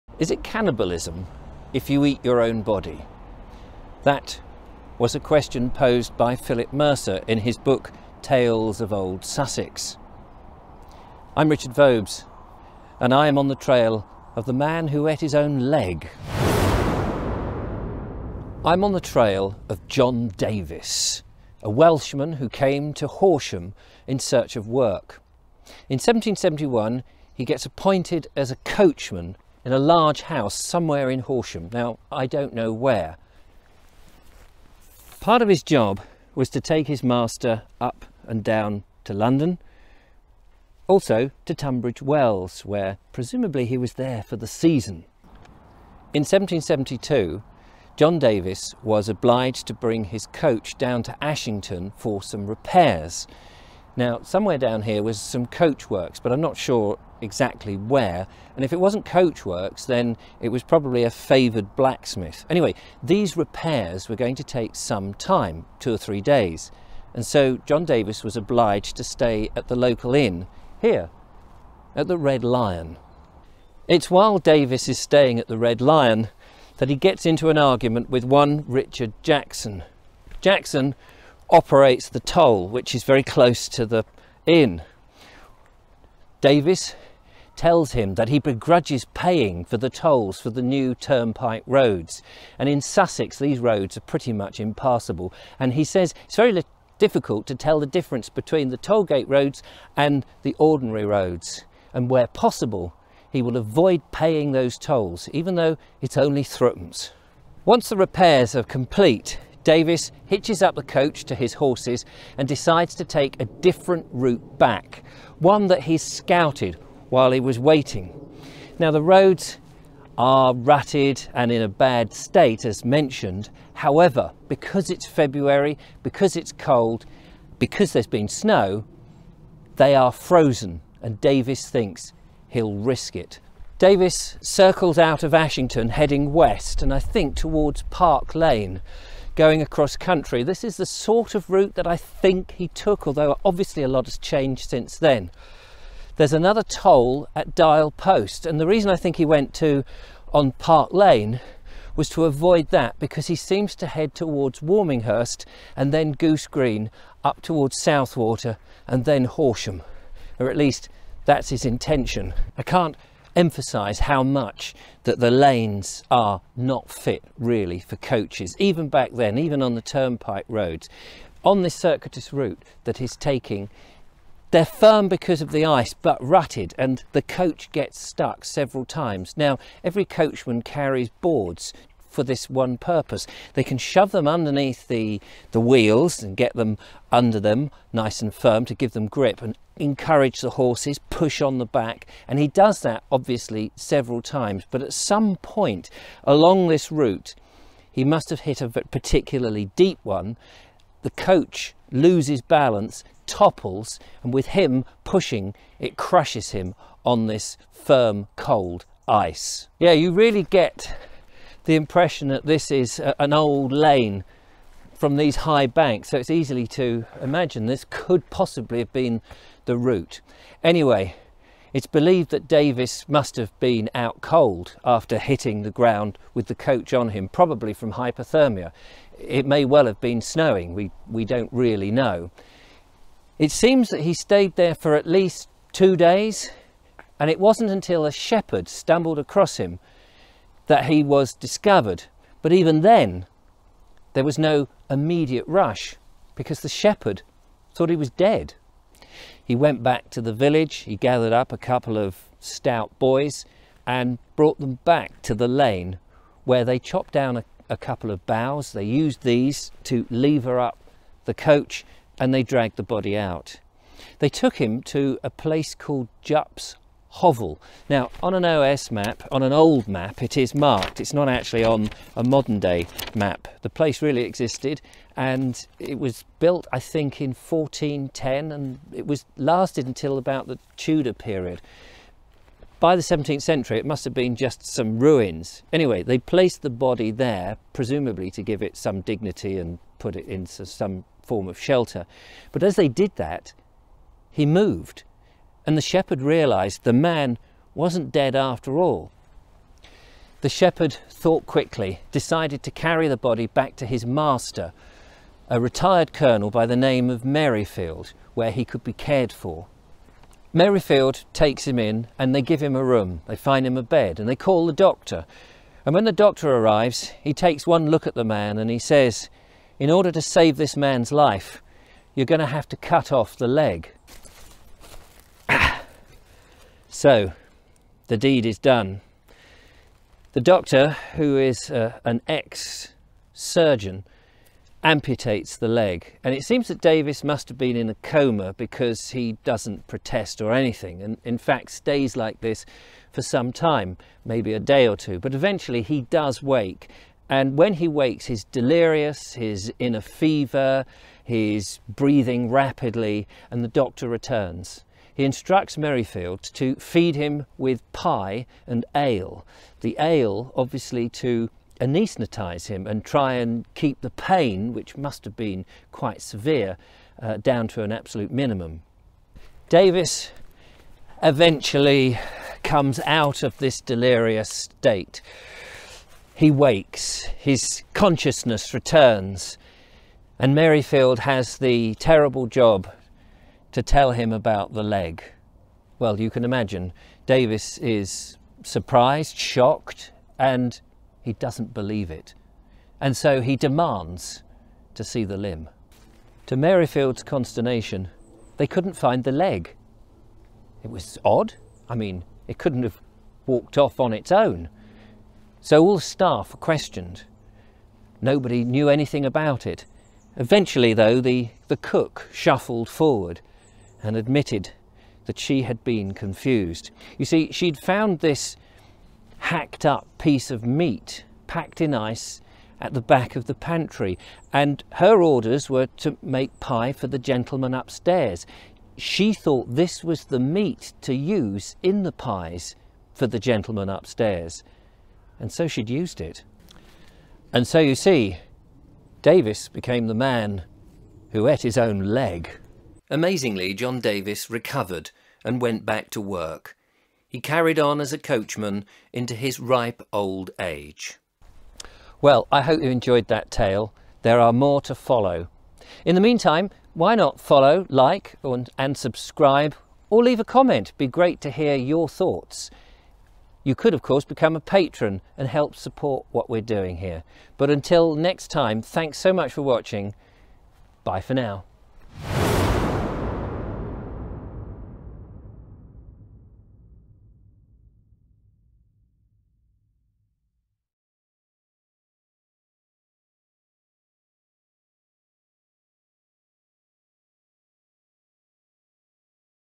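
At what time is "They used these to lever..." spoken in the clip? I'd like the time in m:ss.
4:18.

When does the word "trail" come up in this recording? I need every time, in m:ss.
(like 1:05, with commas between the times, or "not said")
0:13, 0:19.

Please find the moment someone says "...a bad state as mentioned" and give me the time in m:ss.
2:01.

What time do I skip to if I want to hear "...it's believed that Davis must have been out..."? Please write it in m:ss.
3:41.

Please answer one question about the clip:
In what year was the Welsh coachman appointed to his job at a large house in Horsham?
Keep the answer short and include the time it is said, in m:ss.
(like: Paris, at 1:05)
1771, at 0:25.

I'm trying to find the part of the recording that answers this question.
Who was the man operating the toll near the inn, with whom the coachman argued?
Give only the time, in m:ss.
1:18.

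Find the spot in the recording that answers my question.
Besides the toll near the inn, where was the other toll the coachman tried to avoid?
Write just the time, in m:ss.
2:27.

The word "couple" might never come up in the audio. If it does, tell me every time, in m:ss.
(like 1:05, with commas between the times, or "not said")
4:11, 4:17.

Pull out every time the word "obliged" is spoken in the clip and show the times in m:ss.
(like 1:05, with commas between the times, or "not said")
0:49, 1:08.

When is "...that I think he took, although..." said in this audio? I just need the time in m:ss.
2:21.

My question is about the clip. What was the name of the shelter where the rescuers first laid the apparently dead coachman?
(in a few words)
Jupp's Hovel.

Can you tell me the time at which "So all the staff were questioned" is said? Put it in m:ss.
6:45.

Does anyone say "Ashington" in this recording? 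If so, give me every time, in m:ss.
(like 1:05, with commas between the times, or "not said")
0:51, 2:15.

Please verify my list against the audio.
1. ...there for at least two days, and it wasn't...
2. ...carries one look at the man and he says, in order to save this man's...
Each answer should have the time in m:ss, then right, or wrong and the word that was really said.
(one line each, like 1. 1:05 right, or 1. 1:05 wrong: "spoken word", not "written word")
1. 3:54 right
2. 5:17 wrong: "takes", not "carries".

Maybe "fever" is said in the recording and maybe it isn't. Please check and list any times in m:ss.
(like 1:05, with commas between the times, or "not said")
5:50.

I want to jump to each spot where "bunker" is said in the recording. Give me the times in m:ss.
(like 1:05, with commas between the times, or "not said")
not said.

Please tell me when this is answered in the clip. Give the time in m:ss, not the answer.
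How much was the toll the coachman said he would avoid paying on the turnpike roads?
1:46.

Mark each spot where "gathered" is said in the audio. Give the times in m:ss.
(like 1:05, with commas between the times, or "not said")
4:10.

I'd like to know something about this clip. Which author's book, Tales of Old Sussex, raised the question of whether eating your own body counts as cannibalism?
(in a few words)
Philip Mercer.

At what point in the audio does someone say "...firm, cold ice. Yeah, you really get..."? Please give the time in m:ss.
3:27.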